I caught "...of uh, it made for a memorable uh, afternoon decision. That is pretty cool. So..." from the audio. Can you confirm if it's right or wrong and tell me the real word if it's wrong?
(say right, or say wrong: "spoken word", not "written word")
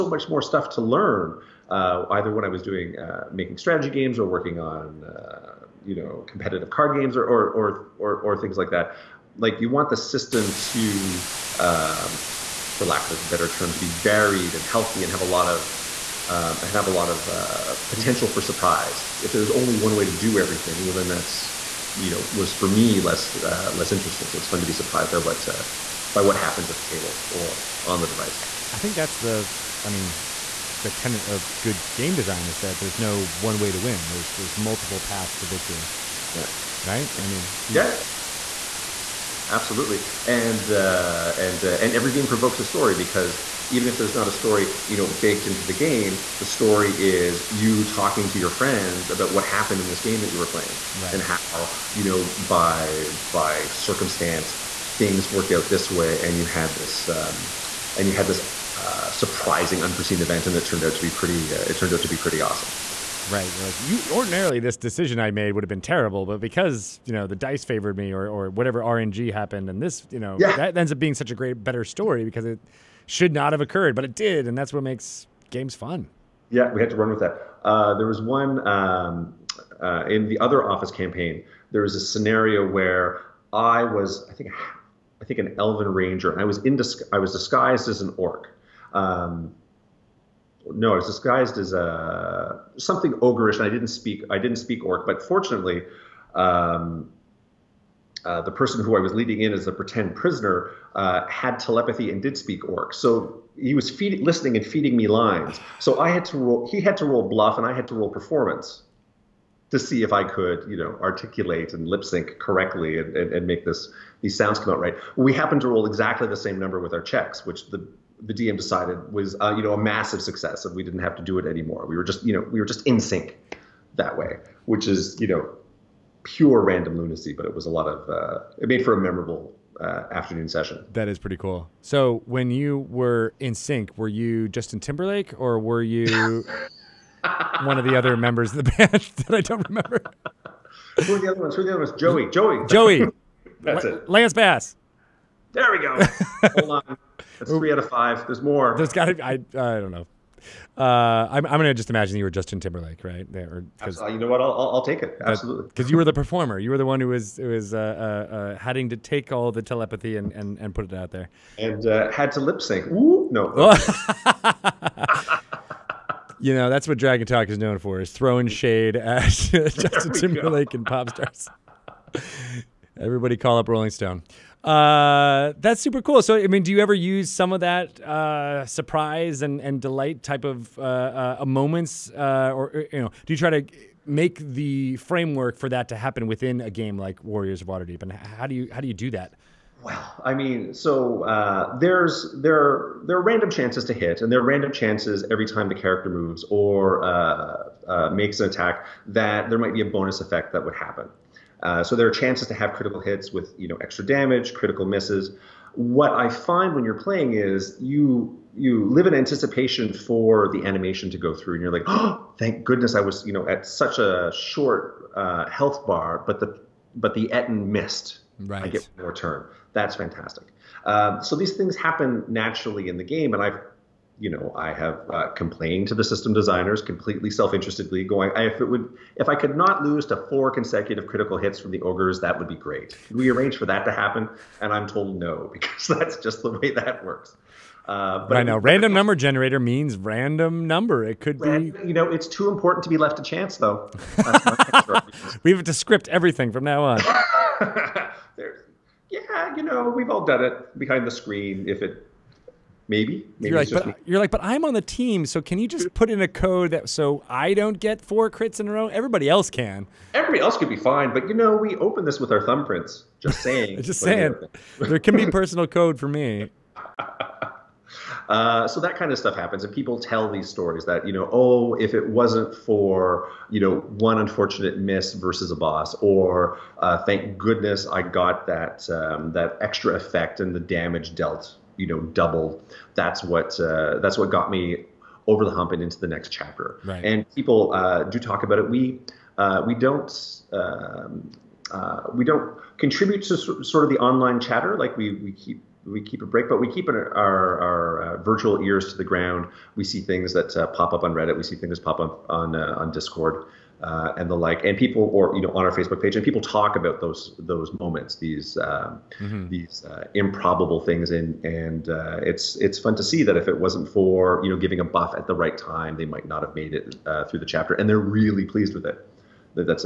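wrong: "session", not "decision".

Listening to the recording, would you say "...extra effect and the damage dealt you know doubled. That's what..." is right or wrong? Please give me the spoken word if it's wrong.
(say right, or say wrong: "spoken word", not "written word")
right.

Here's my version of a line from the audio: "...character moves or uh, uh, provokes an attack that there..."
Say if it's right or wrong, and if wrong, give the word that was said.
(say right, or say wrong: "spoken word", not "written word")
wrong: "makes", not "provokes".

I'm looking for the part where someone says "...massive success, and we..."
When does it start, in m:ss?
1:59.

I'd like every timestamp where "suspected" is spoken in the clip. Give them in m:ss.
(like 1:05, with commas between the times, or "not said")
not said.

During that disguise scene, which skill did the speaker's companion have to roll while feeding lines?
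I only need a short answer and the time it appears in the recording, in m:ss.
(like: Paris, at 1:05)
bluff, at 1:47.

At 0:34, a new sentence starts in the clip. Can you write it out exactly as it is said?
There's there's multiple paths to victory.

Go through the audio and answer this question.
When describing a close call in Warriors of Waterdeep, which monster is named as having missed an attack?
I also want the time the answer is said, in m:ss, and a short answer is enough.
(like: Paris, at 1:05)
Ettin, at 3:37.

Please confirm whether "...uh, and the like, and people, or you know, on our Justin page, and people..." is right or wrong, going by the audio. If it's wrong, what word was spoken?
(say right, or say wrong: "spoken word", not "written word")
wrong: "Facebook", not "Justin".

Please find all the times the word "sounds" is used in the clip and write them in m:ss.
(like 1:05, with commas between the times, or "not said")
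1:54.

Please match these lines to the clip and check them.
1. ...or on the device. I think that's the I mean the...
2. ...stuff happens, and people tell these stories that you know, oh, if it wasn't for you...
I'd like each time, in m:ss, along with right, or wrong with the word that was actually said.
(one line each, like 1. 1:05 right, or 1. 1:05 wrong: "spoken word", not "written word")
1. 0:27 right
2. 4:29 right.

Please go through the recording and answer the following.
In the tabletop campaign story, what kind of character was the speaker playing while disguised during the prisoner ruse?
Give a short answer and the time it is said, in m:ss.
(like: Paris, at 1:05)
elven ranger, at 1:25.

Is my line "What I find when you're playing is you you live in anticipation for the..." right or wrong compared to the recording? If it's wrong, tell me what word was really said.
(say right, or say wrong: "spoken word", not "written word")
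right.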